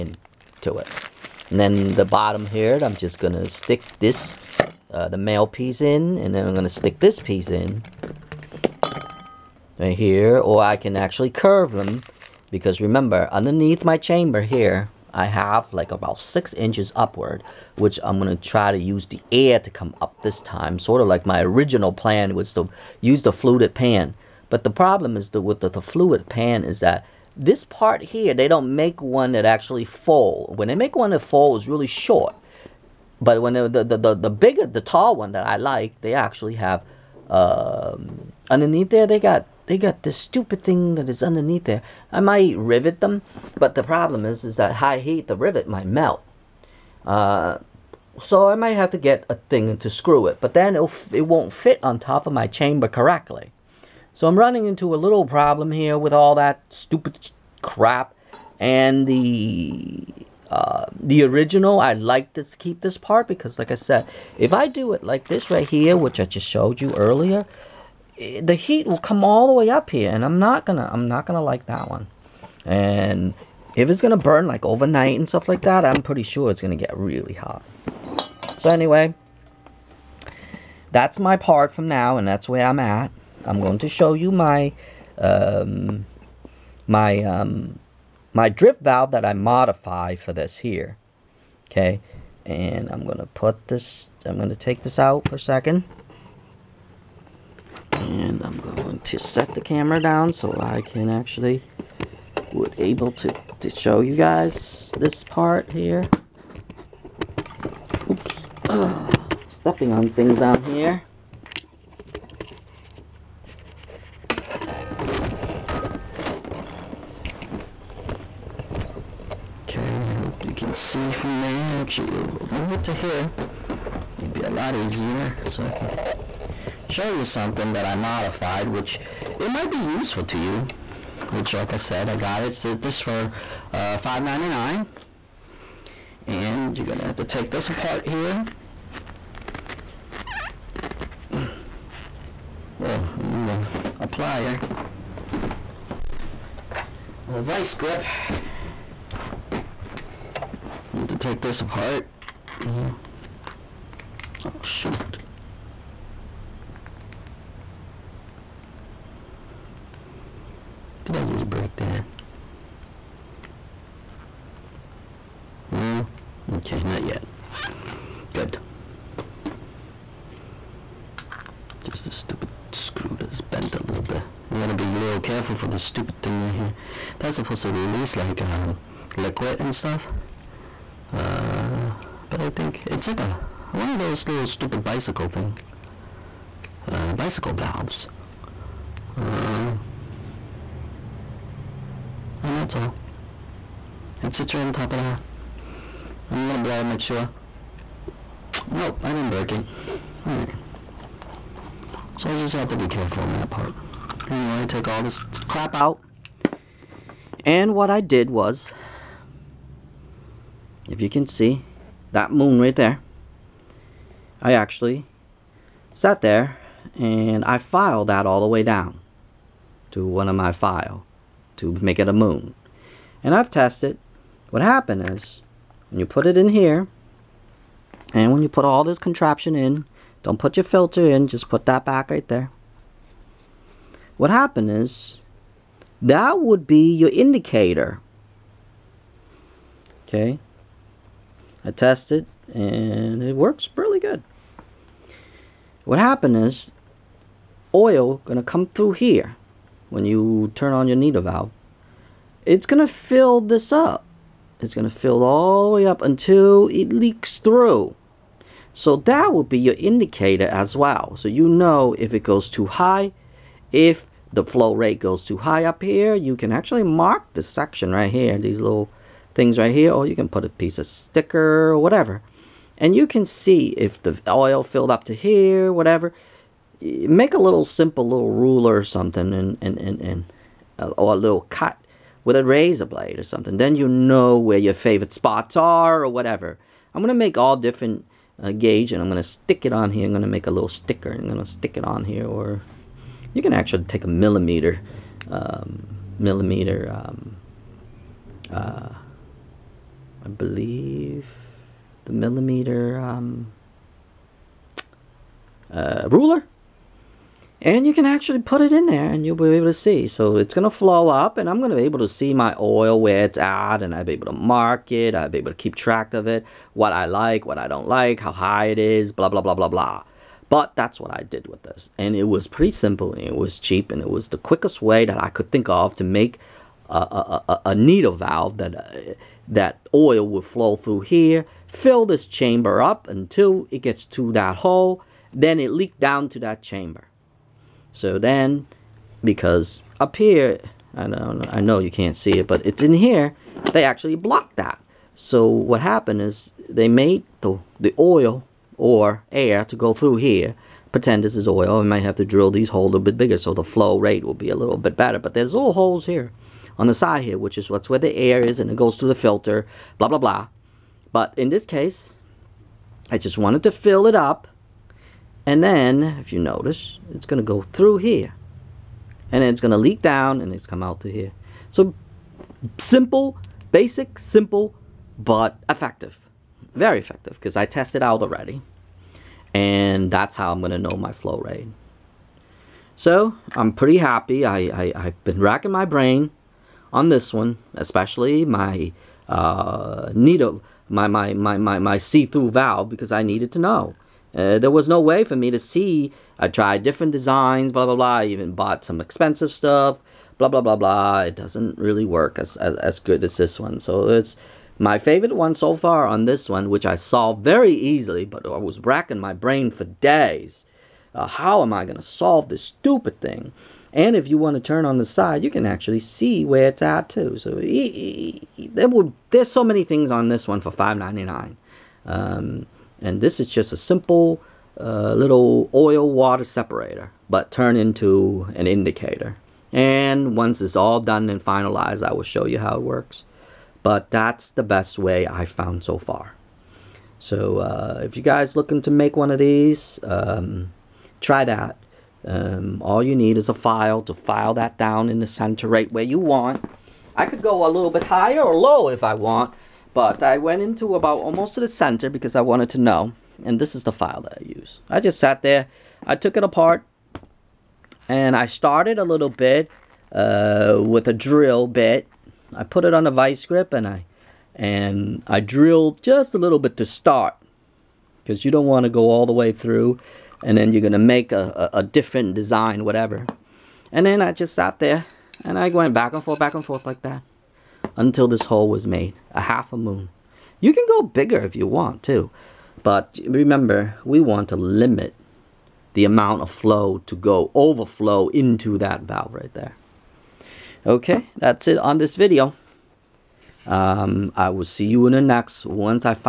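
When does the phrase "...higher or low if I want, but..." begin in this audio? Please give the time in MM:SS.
07:28.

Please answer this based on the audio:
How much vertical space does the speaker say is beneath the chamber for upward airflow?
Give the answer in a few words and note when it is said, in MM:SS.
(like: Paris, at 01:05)
6 inches, at 00:16.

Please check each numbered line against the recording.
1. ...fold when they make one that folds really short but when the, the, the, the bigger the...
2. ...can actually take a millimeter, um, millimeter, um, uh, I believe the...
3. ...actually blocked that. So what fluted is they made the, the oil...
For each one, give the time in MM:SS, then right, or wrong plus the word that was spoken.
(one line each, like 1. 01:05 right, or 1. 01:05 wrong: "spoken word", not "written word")
1. 00:29 right
2. 04:53 right
3. 05:43 wrong: "happened", not "fluted".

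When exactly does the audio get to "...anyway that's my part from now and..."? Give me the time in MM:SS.
01:18.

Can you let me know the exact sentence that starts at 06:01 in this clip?
But in this case, I just wanted to fill it up and then, if you notice, it's going to go through here.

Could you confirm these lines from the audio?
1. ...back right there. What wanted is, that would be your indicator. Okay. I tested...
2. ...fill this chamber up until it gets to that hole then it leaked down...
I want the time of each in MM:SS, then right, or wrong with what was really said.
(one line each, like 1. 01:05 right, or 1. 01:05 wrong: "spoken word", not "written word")
1. 03:51 wrong: "happened", not "wanted"
2. 05:31 right.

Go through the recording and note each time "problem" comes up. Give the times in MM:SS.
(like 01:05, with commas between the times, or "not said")
00:24, 00:43, 00:55.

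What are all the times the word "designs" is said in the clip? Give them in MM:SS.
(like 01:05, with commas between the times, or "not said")
06:37, 07:52.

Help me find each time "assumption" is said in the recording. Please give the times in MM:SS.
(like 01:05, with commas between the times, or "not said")
not said.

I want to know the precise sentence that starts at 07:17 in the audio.
So uh, if you guys looking to make one of these, um, try that.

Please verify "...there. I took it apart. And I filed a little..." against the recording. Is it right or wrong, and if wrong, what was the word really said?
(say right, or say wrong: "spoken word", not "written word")
wrong: "started", not "filed".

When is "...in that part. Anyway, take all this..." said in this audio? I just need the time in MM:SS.
03:23.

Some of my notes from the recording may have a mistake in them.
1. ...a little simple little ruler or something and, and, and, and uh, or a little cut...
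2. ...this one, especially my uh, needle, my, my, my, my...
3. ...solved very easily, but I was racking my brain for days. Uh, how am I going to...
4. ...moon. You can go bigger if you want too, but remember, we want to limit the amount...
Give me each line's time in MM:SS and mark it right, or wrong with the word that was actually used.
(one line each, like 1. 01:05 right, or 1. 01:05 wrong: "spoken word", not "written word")
1. 04:37 right
2. 06:27 right
3. 06:46 right
4. 07:59 right.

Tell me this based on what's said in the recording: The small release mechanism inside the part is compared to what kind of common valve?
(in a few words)
bicycle valves.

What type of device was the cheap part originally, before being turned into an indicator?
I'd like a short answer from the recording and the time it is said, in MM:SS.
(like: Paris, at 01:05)
oil water separator, at 07:05.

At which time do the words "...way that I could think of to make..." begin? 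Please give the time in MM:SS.
05:24.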